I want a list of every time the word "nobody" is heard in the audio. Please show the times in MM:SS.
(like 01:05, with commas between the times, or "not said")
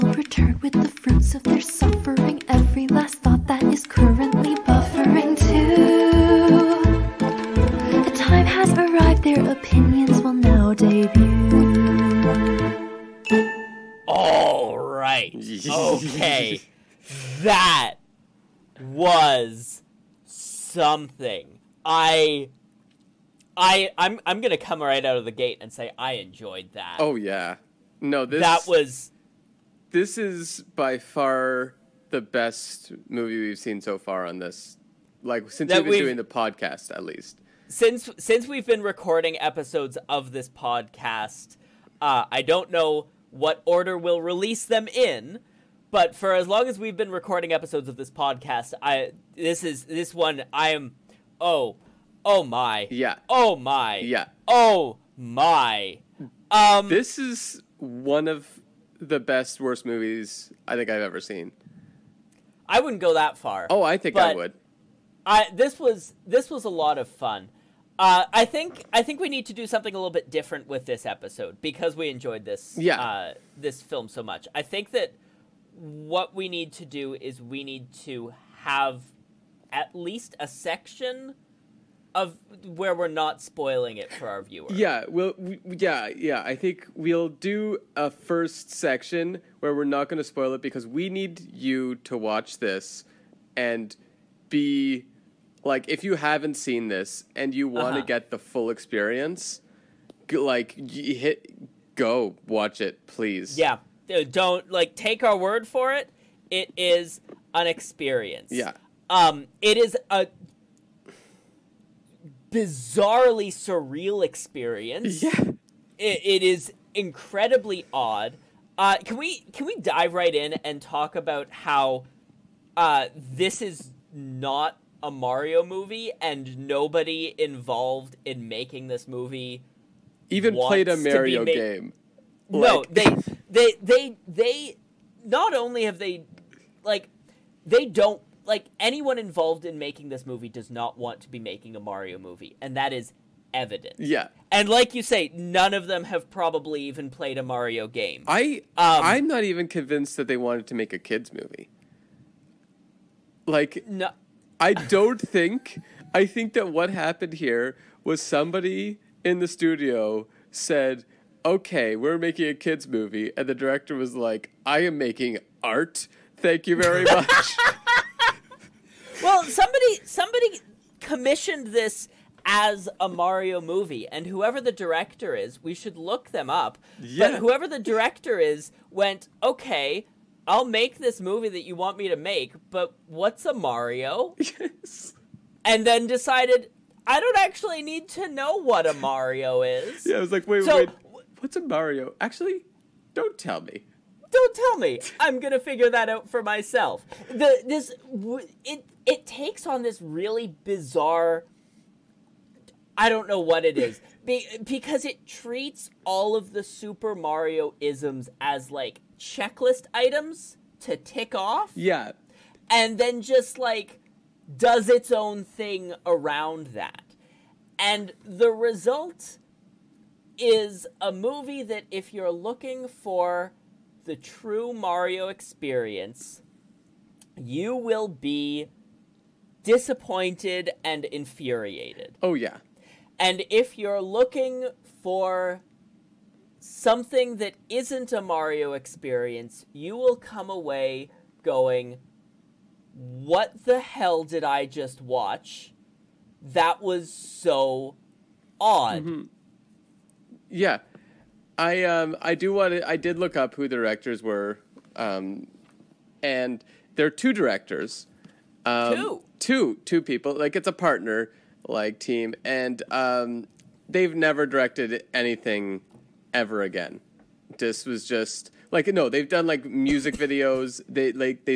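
02:06.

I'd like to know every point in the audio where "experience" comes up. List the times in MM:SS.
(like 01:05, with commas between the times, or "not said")
01:38, 01:47, 01:54, 03:45, 03:58.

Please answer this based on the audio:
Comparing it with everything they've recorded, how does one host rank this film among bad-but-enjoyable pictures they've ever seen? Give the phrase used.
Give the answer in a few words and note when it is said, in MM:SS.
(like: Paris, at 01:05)
best worst movies, at 00:59.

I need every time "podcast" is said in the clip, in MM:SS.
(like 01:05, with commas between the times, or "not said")
00:36, 00:40, 00:48.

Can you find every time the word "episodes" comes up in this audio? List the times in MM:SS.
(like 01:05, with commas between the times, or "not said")
00:39, 00:47, 01:11.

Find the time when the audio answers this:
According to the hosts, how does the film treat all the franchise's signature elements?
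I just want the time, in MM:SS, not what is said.
03:29.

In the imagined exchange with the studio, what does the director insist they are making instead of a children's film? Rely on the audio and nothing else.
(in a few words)
art.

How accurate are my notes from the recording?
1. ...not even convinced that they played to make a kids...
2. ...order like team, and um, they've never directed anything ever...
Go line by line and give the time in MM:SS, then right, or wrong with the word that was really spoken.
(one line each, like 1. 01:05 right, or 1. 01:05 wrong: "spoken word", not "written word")
1. 02:29 wrong: "wanted", not "played"
2. 04:20 wrong: "partner", not "order".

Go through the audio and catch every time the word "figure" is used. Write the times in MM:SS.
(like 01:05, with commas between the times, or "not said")
03:15.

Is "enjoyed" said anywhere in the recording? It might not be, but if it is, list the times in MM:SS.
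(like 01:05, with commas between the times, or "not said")
00:26, 01:12.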